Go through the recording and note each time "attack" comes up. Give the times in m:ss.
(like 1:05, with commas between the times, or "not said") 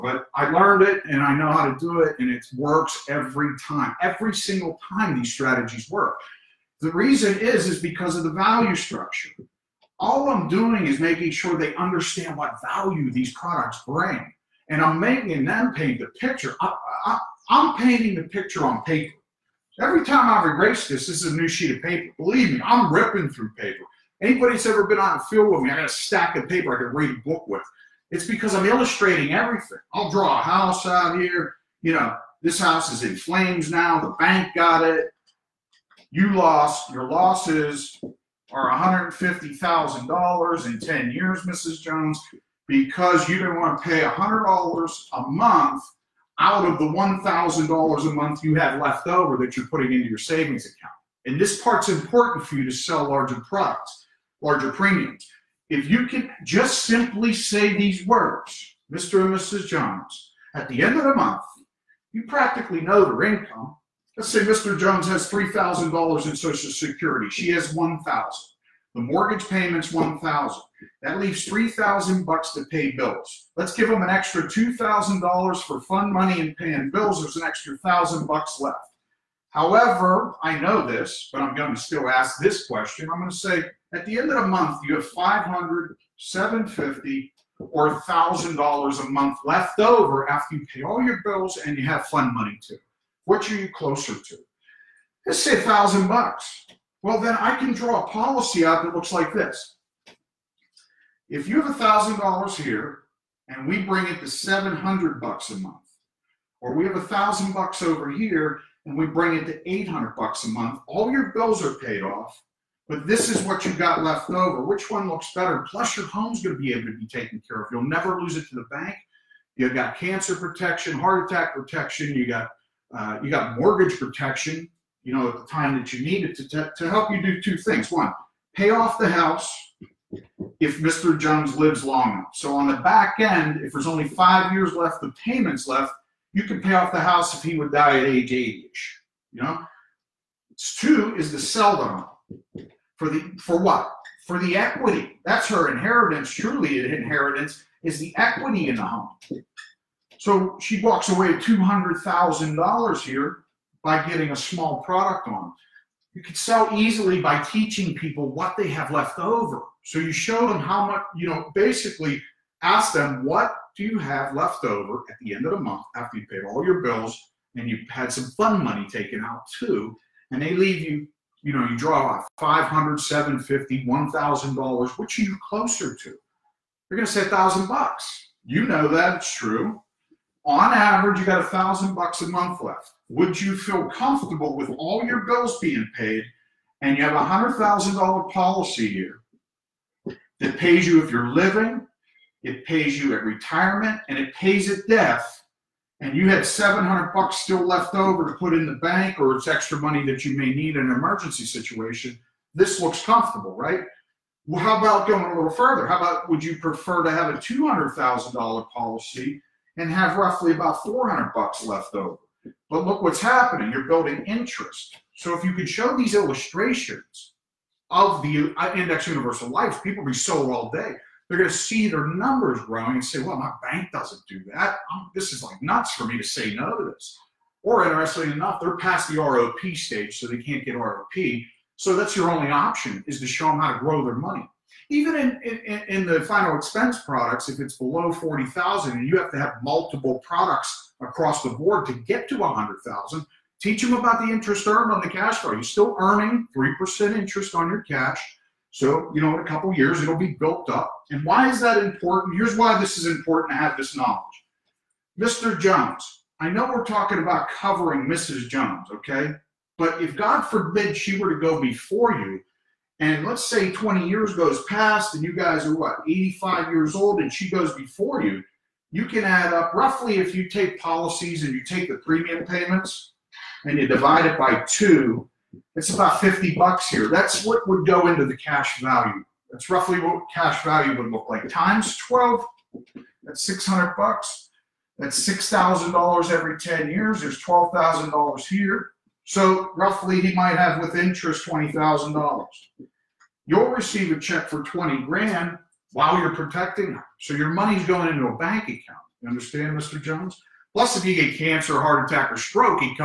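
2:01, 5:02.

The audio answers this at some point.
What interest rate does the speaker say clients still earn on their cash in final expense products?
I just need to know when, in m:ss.
4:06.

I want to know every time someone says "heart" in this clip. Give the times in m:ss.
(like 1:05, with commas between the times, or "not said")
2:00, 5:01.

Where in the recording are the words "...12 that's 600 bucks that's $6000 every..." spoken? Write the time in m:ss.
4:41.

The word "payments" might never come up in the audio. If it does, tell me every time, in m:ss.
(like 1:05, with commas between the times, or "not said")
1:09, 2:15, 4:32.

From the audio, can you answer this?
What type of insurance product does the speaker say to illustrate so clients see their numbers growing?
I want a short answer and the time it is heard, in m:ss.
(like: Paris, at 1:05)
index universal life, at 3:38.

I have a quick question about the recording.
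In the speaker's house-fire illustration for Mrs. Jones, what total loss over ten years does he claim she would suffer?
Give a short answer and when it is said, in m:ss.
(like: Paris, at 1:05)
$150,000, at 0:39.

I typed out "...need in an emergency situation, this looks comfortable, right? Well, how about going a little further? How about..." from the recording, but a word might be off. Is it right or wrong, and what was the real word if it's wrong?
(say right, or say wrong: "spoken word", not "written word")
right.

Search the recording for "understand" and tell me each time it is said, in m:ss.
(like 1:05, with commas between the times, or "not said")
0:11, 4:59.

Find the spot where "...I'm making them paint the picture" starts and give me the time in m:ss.
0:14.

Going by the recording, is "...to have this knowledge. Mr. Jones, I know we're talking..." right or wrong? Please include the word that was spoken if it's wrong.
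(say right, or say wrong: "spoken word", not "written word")
right.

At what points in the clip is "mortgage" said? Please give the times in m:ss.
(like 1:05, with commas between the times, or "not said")
1:09, 2:03.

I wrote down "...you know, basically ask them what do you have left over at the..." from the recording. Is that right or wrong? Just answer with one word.
right.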